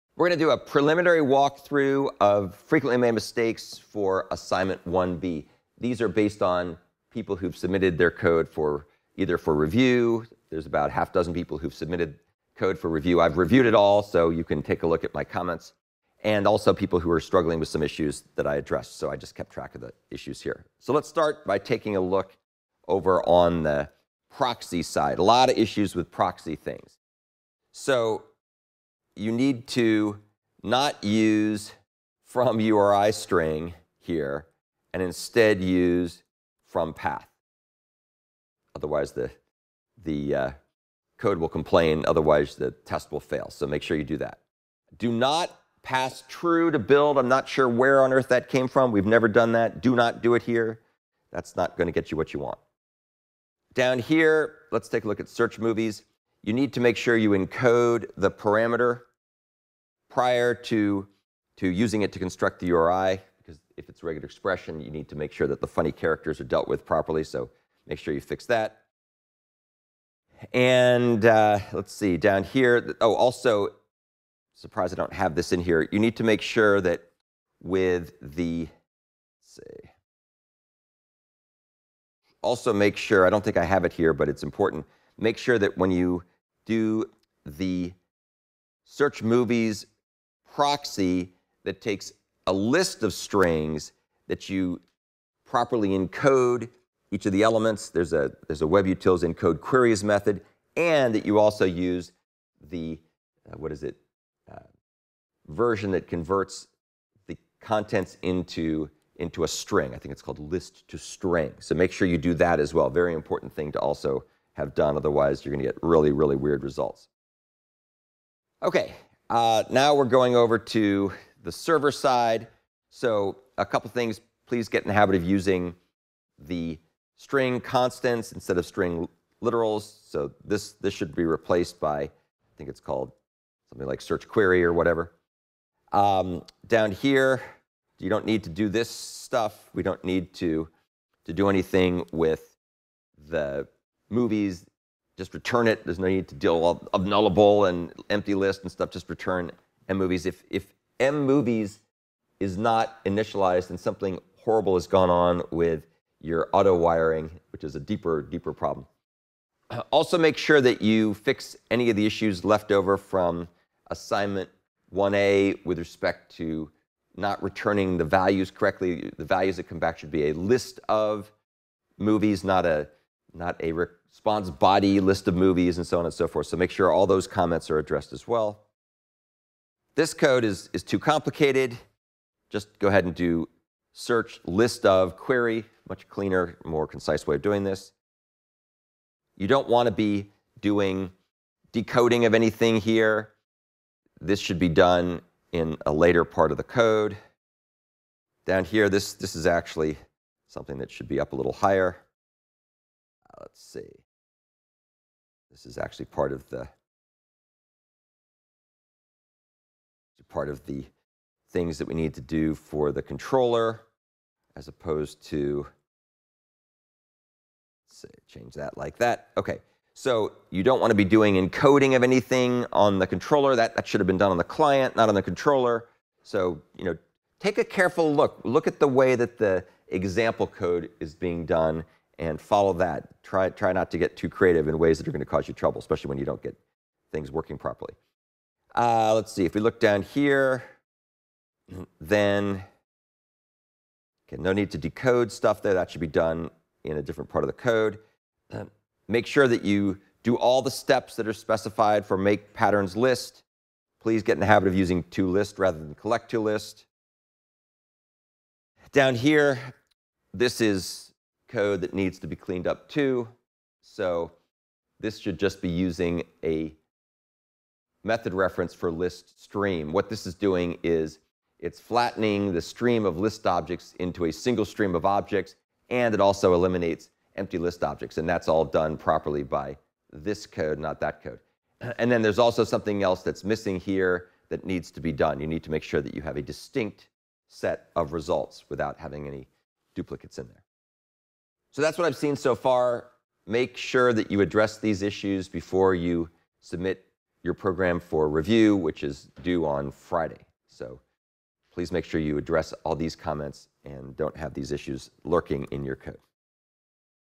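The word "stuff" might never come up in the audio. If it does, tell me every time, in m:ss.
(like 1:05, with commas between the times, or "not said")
2:18, 2:28, 4:05.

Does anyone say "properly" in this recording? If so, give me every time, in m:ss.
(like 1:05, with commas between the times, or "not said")
1:06, 1:35, 3:57, 4:38.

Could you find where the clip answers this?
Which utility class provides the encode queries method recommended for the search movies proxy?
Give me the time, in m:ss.
1:38.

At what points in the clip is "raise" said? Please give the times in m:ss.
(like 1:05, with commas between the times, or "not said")
not said.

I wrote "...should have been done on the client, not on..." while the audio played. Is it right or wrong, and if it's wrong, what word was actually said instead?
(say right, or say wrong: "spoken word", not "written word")
right.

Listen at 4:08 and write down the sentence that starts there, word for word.
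Uh, make sure that you do all the steps that are specified for make patterns list.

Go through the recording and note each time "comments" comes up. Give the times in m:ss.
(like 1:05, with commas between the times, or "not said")
0:15, 2:57, 5:03.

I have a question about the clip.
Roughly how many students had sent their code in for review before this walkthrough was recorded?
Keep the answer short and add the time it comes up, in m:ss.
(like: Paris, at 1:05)
half dozen, at 0:10.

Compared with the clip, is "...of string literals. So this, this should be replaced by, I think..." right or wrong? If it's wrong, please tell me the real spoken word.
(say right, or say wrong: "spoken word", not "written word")
right.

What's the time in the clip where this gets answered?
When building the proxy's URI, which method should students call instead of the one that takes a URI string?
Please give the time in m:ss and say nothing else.
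0:36.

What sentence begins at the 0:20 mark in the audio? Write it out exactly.
So let's start by taking a look over on the proxy side.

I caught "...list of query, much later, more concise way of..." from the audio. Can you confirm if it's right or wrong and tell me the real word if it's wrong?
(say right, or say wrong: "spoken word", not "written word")
wrong: "cleaner", not "later".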